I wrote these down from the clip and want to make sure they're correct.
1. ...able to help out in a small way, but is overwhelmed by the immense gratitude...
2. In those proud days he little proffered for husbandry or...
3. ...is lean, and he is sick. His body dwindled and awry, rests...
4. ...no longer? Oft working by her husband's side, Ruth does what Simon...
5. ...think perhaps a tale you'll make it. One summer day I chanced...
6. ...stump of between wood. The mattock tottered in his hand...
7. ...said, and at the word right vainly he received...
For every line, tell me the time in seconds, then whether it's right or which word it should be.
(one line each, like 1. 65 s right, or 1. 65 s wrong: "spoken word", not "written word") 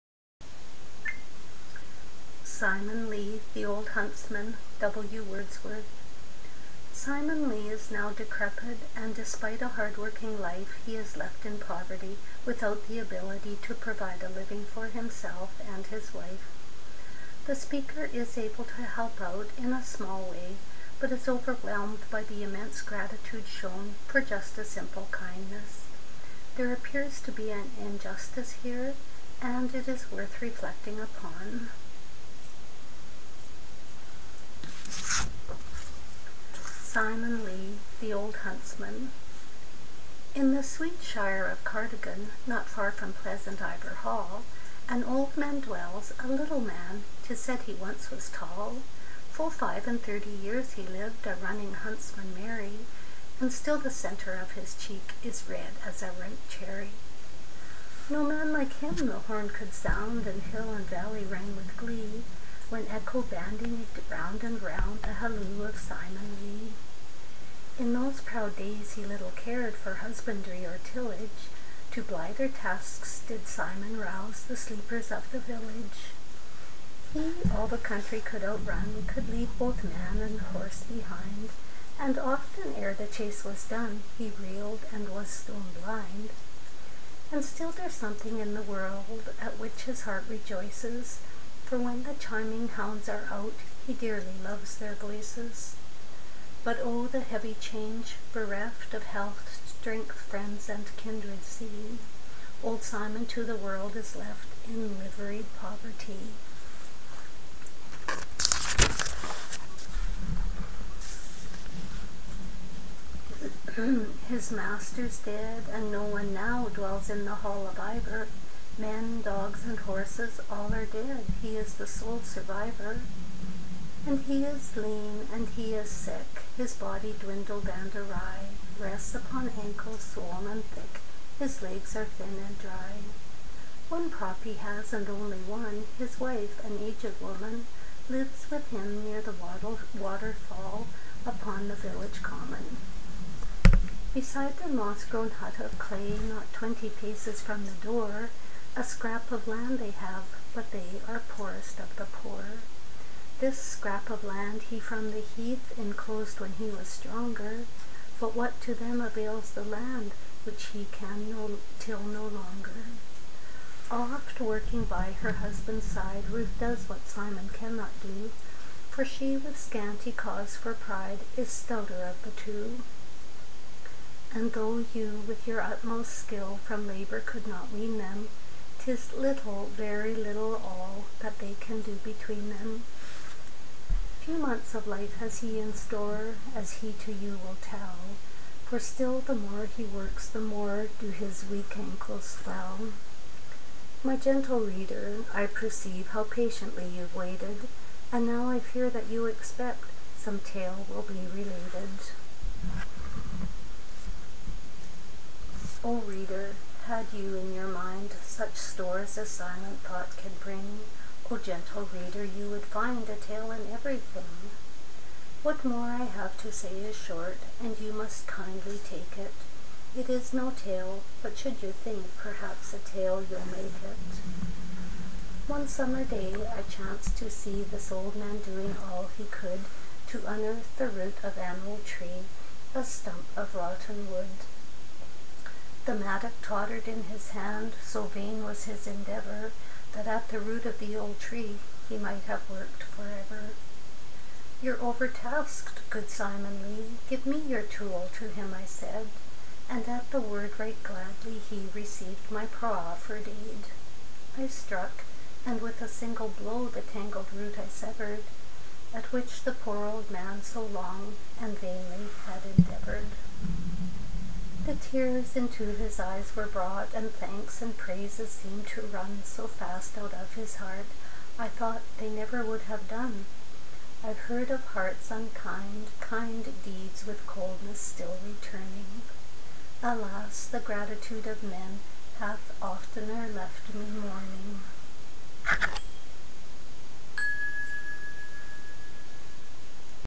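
1. 18 s right
2. 67 s wrong: "cared", not "proffered"
3. 124 s right
4. 161 s right
5. 221 s right
6. 232 s wrong: "rotten", not "between"
7. 248 s wrong: "gladly", not "vainly".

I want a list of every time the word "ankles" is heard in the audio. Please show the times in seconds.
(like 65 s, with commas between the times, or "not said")
129 s, 191 s.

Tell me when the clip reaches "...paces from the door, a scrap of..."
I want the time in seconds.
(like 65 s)
146 s.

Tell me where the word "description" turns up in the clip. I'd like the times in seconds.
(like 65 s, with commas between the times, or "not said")
not said.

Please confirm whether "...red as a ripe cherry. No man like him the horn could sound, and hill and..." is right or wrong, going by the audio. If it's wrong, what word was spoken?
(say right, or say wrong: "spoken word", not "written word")
right.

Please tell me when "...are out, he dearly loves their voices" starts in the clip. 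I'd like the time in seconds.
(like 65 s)
93 s.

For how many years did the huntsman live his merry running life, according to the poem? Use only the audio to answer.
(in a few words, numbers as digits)
35.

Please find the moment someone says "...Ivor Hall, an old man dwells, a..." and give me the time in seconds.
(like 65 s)
43 s.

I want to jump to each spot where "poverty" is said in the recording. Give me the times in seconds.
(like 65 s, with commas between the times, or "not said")
11 s, 105 s.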